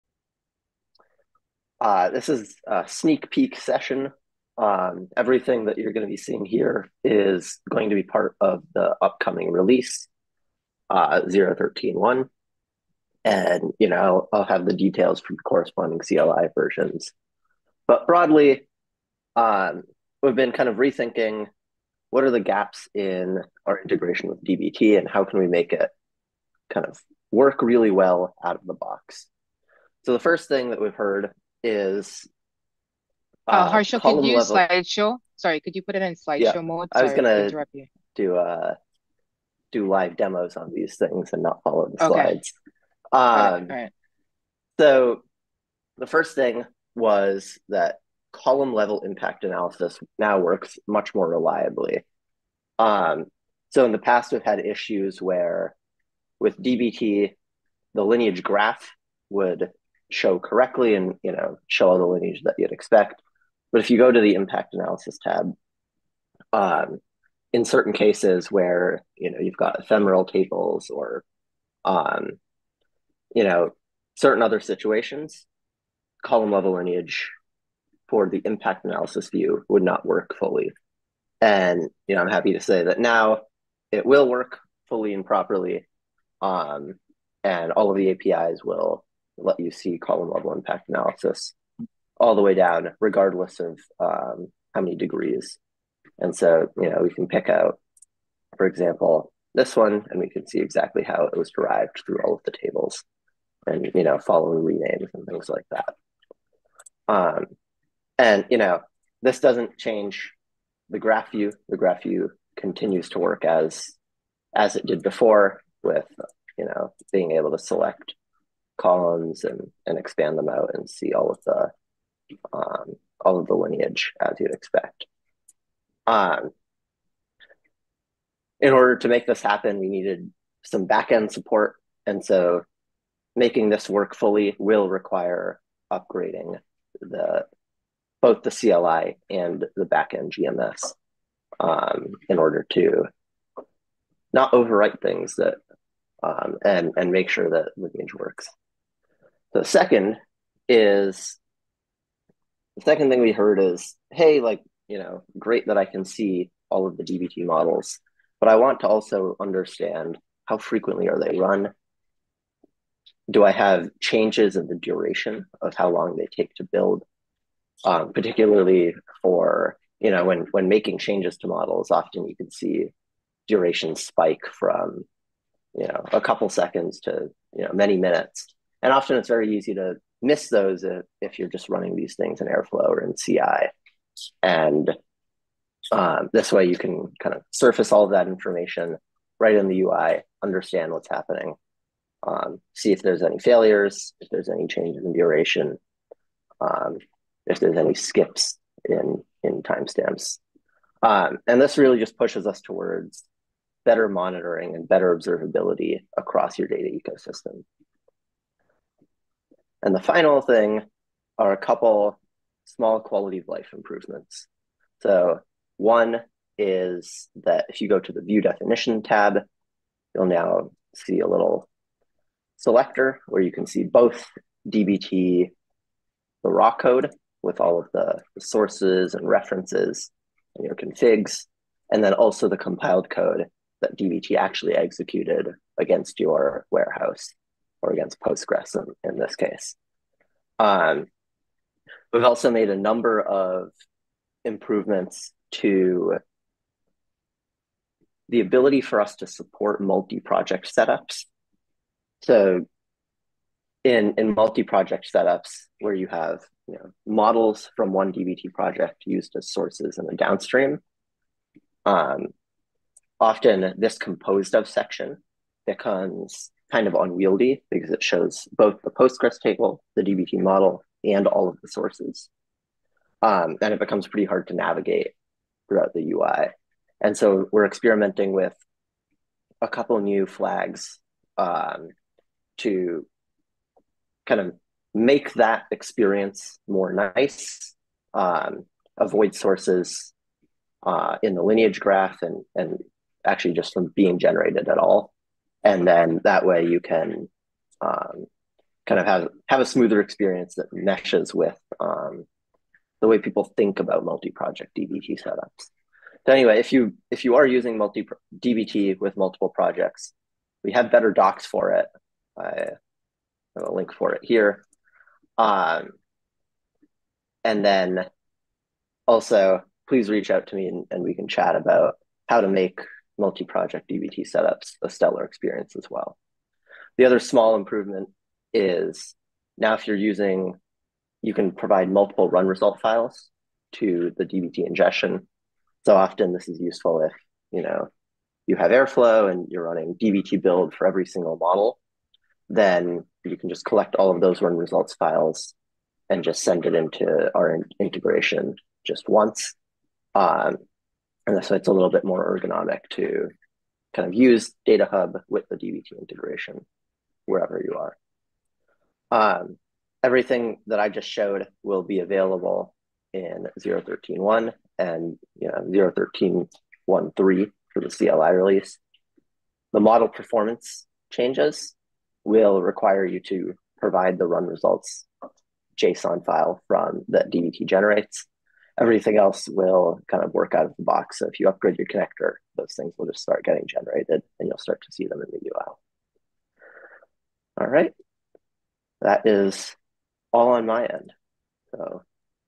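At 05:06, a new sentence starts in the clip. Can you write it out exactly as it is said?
So anyway, if you if you are using multi DBT with multiple projects, we have better docs for it.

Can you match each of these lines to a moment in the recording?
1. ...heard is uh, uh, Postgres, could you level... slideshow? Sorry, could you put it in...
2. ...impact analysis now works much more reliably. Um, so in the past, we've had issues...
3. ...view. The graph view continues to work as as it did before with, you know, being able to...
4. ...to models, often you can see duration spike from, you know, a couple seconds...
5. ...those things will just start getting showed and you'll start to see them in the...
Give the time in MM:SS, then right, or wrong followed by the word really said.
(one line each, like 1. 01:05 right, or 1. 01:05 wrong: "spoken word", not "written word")
1. 00:30 wrong: "Harshal", not "Postgres"
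2. 00:49 right
3. 01:51 right
4. 02:51 right
5. 06:22 wrong: "generated", not "showed".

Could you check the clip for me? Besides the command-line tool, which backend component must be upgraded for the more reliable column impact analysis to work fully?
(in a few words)
GMS.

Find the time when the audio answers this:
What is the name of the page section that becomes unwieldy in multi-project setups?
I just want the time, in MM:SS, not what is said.
04:23.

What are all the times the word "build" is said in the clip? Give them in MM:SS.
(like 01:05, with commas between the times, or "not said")
02:46, 05:40.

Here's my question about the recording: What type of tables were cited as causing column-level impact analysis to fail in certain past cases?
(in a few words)
ephemeral tables.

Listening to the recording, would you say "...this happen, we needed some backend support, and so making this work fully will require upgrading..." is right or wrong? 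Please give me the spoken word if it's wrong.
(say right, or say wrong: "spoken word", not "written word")
right.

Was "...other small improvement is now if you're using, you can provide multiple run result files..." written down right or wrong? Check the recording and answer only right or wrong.
right.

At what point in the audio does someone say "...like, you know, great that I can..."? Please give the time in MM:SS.
02:34.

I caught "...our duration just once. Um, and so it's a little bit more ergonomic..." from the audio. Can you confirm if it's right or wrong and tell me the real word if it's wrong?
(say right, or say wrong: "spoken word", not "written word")
wrong: "integration", not "duration".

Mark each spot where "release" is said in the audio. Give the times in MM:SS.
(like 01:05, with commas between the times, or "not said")
00:09, 06:08.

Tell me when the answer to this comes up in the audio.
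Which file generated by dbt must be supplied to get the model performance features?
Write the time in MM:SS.
06:14.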